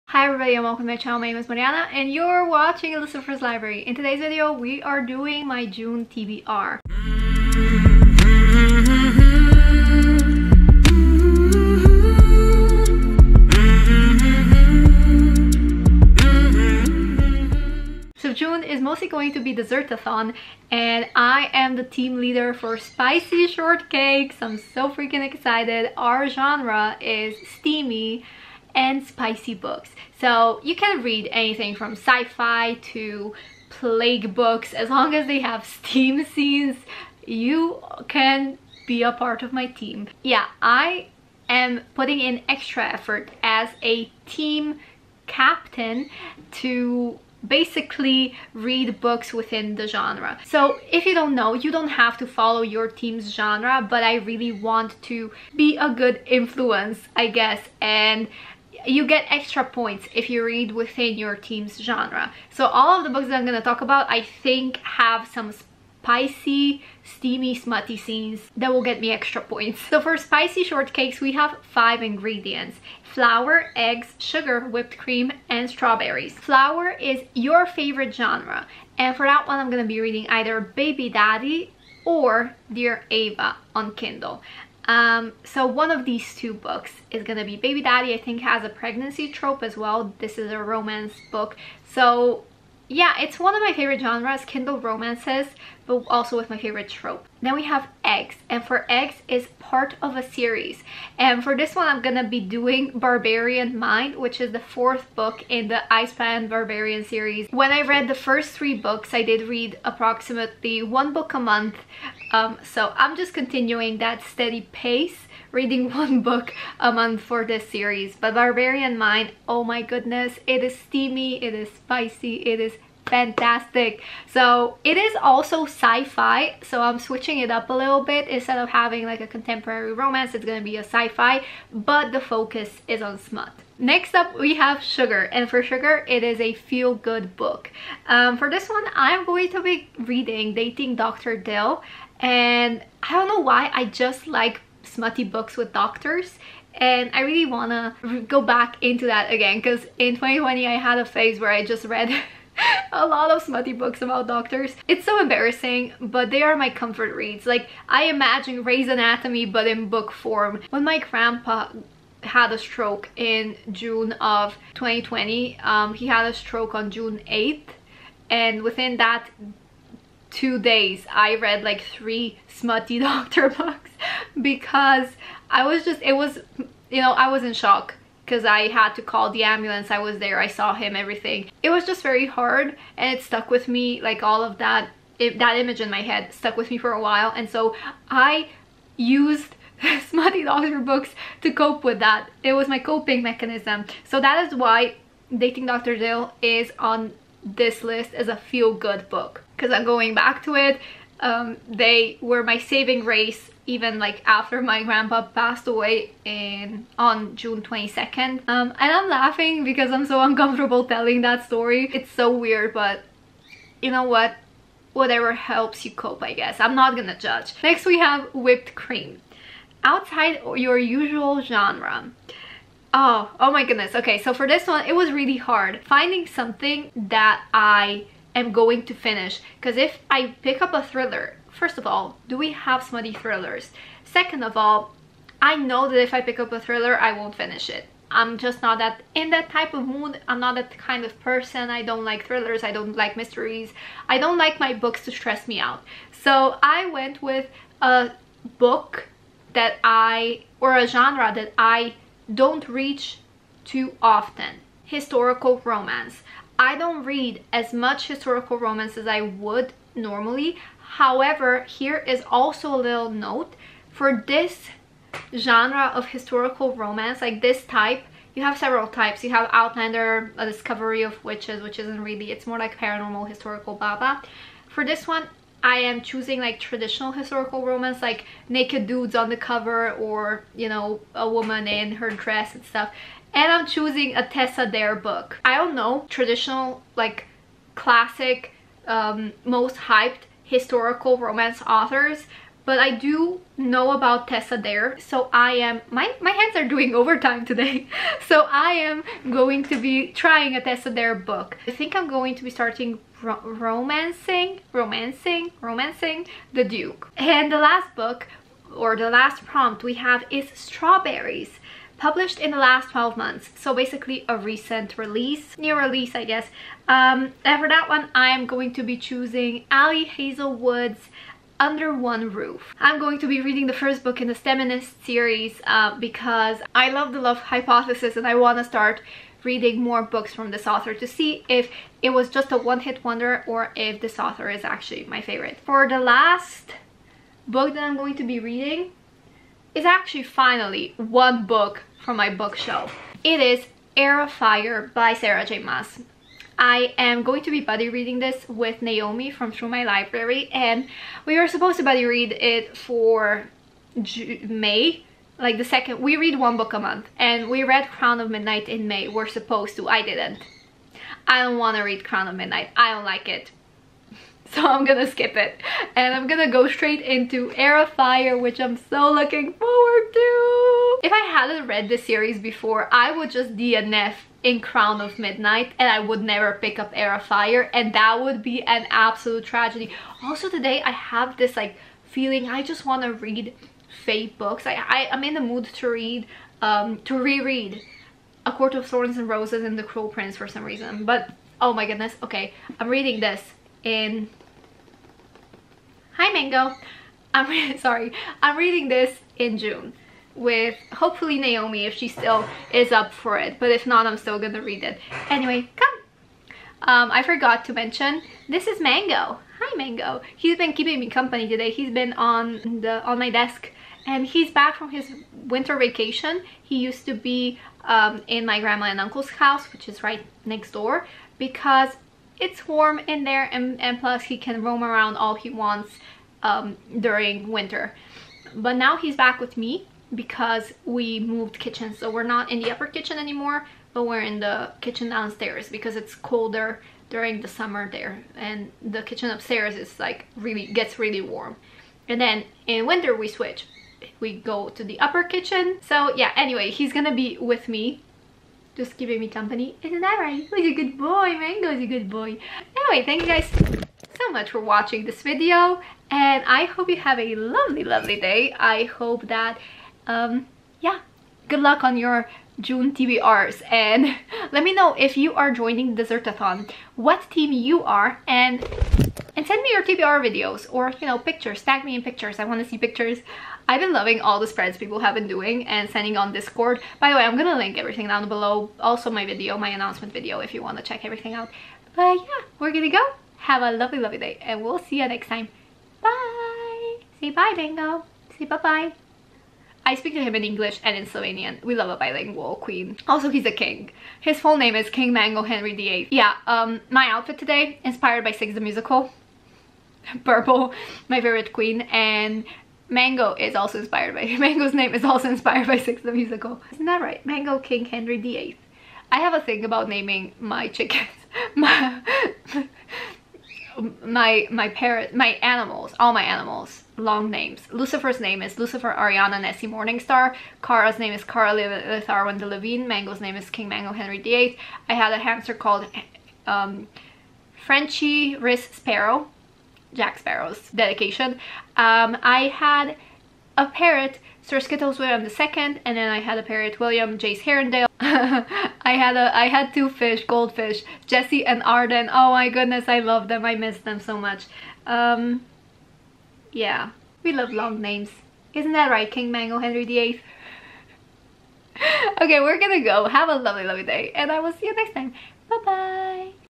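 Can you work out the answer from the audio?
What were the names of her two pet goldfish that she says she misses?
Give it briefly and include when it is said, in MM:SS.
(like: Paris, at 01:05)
Jesse and Arden, at 09:01.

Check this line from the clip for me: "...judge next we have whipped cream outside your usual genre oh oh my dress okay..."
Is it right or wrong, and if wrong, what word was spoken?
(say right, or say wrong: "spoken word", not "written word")
wrong: "goodness", not "dress".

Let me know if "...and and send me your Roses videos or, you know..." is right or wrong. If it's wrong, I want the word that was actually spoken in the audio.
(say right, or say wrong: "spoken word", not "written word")
wrong: "TBR", not "Roses".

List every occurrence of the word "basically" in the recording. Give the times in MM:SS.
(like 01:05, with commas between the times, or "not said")
00:47, 05:13.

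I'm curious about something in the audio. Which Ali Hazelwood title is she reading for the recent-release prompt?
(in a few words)
Under One Roof.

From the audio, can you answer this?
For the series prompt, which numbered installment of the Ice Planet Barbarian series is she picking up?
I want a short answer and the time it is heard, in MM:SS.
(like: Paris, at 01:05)
4th, at 01:44.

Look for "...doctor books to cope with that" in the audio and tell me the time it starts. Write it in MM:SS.
03:10.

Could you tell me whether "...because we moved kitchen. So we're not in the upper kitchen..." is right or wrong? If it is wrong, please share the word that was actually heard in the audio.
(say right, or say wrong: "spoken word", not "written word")
right.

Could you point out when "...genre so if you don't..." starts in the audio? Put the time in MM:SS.
00:49.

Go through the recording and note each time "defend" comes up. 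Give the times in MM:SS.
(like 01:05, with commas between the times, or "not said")
not said.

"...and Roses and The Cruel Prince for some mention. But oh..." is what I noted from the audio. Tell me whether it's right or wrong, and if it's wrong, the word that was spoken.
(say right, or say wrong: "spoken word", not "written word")
wrong: "reason", not "mention".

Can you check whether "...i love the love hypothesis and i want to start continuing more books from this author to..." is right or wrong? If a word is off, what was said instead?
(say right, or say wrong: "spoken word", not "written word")
wrong: "reading", not "continuing".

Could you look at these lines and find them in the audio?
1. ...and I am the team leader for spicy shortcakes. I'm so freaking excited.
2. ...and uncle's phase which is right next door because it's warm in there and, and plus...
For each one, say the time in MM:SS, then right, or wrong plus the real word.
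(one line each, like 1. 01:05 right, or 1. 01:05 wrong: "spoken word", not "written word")
1. 00:20 right
2. 06:58 wrong: "house", not "phase".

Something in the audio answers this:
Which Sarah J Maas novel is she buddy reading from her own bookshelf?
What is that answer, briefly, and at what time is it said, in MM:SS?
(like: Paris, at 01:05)
Heir of Fire, at 05:43.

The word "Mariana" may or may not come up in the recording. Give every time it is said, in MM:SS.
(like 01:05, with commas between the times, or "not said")
00:01.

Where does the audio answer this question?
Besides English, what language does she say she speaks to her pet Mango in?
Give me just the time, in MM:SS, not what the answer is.
08:11.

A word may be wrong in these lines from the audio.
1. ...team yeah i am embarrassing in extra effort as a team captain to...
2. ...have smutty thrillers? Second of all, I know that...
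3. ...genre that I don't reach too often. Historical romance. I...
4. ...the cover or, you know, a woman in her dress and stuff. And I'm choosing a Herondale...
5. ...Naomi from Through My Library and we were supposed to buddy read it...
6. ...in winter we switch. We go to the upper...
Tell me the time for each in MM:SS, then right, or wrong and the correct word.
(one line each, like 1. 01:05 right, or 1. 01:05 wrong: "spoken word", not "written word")
1. 00:39 wrong: "putting", not "embarrassing"
2. 03:52 right
3. 04:10 right
4. 04:39 wrong: "Tessa", not "Herondale"
5. 05:48 right
6. 07:22 right.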